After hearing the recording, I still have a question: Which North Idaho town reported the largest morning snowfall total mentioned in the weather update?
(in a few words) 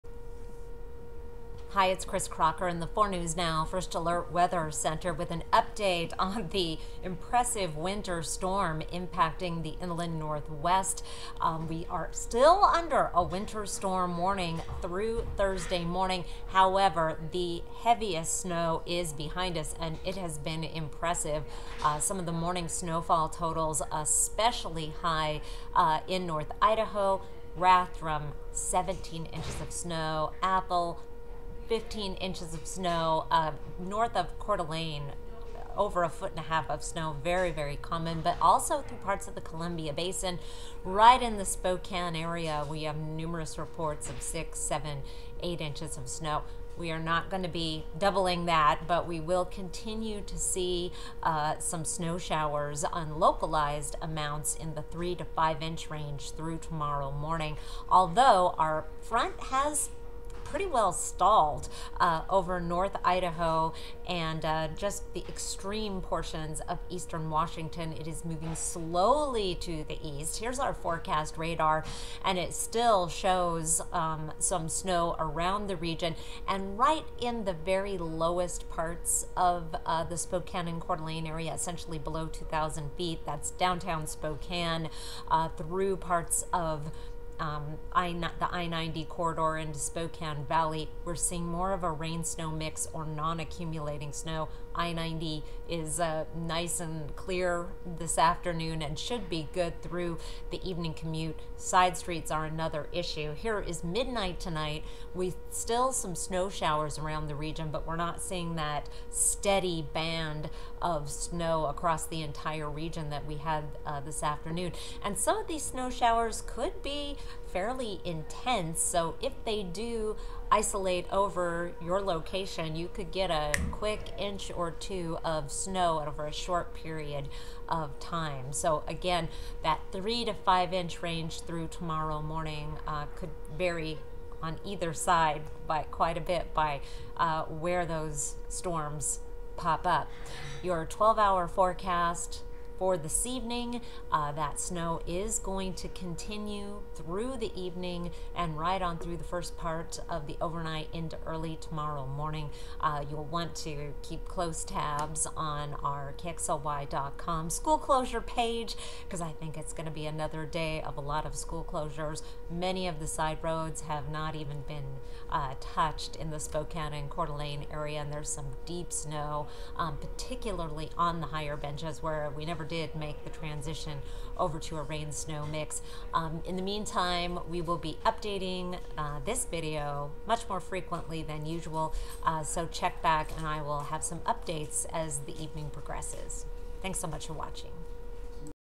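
Rathdrum.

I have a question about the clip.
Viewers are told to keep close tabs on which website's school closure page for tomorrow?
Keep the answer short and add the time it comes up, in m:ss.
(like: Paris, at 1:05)
KXLY.com, at 2:36.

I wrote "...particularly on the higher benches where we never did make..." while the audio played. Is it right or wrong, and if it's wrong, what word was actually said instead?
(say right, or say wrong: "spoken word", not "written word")
right.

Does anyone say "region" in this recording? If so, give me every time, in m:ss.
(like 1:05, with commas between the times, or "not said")
1:15, 1:47, 1:52.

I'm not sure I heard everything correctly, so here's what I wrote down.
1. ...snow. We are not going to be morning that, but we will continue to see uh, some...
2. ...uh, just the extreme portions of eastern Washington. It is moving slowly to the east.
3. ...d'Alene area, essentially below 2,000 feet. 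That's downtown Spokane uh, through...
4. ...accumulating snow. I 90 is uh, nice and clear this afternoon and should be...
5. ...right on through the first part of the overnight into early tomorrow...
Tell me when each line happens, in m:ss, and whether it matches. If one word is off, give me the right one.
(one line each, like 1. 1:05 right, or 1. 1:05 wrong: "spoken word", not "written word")
1. 0:46 wrong: "doubling", not "morning"
2. 1:04 right
3. 1:20 right
4. 1:33 right
5. 2:28 right.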